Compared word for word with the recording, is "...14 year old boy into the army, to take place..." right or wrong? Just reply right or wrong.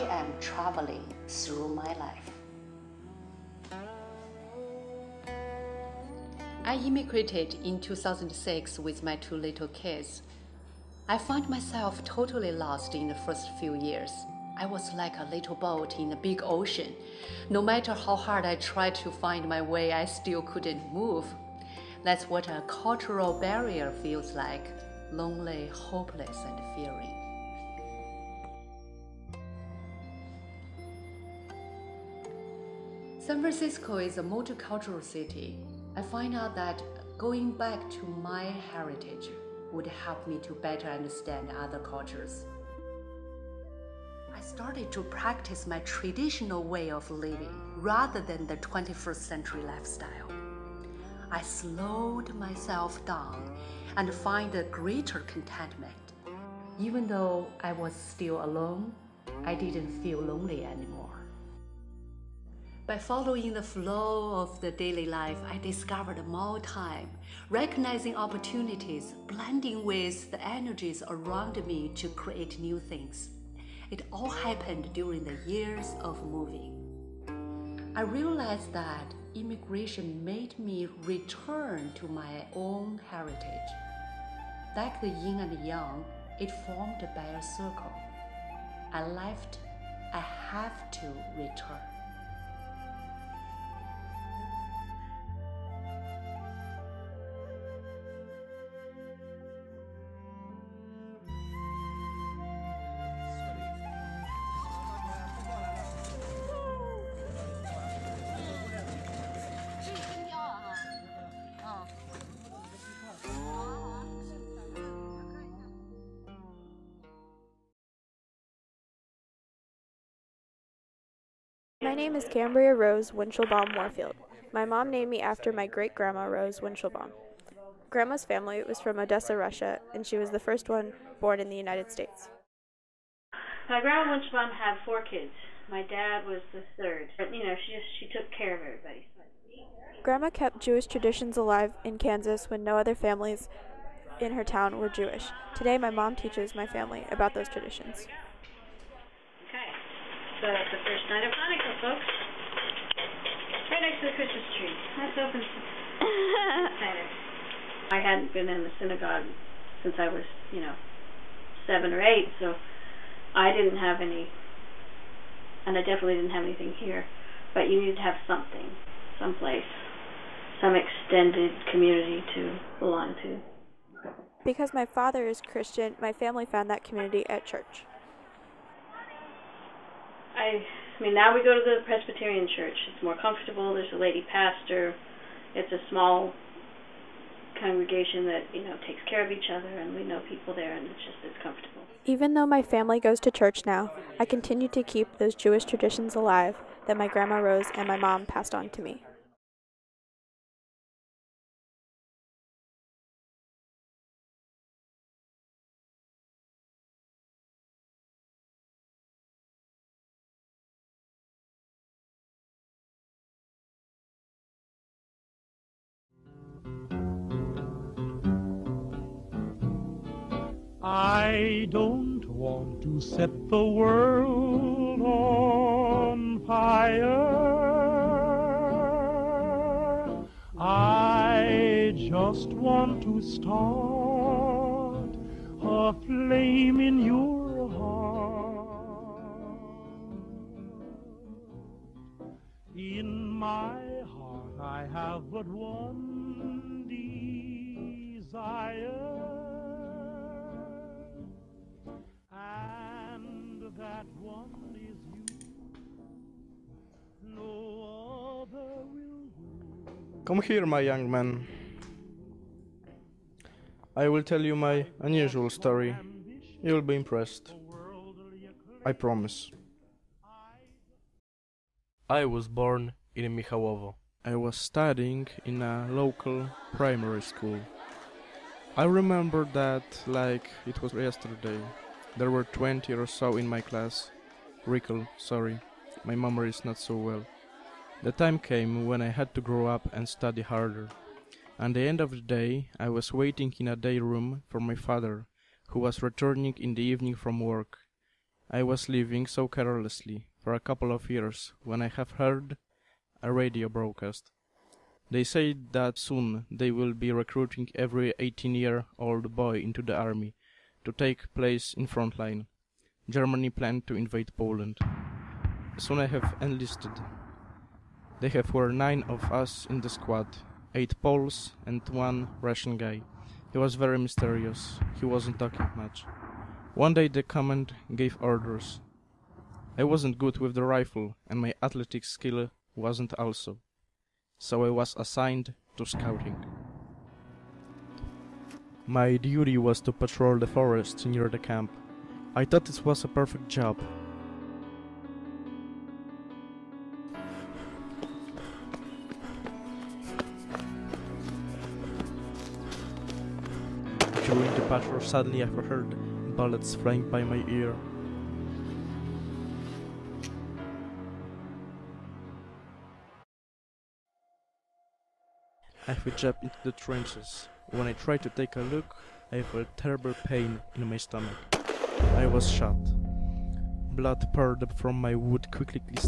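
wrong.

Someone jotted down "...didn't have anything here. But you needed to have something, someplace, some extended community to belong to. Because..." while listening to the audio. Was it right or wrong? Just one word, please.
right.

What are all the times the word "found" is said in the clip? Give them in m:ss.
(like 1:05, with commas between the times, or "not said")
0:11, 2:56.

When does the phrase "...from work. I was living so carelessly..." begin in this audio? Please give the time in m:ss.
4:57.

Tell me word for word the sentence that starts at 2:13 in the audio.
My grandma Winchelbaum had four kids.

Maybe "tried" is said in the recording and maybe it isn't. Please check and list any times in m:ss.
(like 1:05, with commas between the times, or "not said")
0:18, 6:07.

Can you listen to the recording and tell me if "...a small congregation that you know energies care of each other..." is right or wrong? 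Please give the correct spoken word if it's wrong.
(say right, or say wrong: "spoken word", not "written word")
wrong: "takes", not "energies".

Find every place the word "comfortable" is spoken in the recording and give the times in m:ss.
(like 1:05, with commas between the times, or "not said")
3:03, 3:11.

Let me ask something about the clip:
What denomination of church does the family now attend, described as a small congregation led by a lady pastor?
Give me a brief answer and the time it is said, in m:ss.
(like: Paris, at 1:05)
Presbyterian, at 3:01.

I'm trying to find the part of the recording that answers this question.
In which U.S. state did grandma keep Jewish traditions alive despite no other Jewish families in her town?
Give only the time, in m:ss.
2:21.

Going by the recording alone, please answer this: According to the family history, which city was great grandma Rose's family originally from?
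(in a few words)
Odessa.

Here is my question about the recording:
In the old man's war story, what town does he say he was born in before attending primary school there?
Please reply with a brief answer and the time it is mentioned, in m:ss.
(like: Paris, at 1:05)
Michałowo, at 4:33.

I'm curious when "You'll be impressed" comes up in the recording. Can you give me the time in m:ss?
4:26.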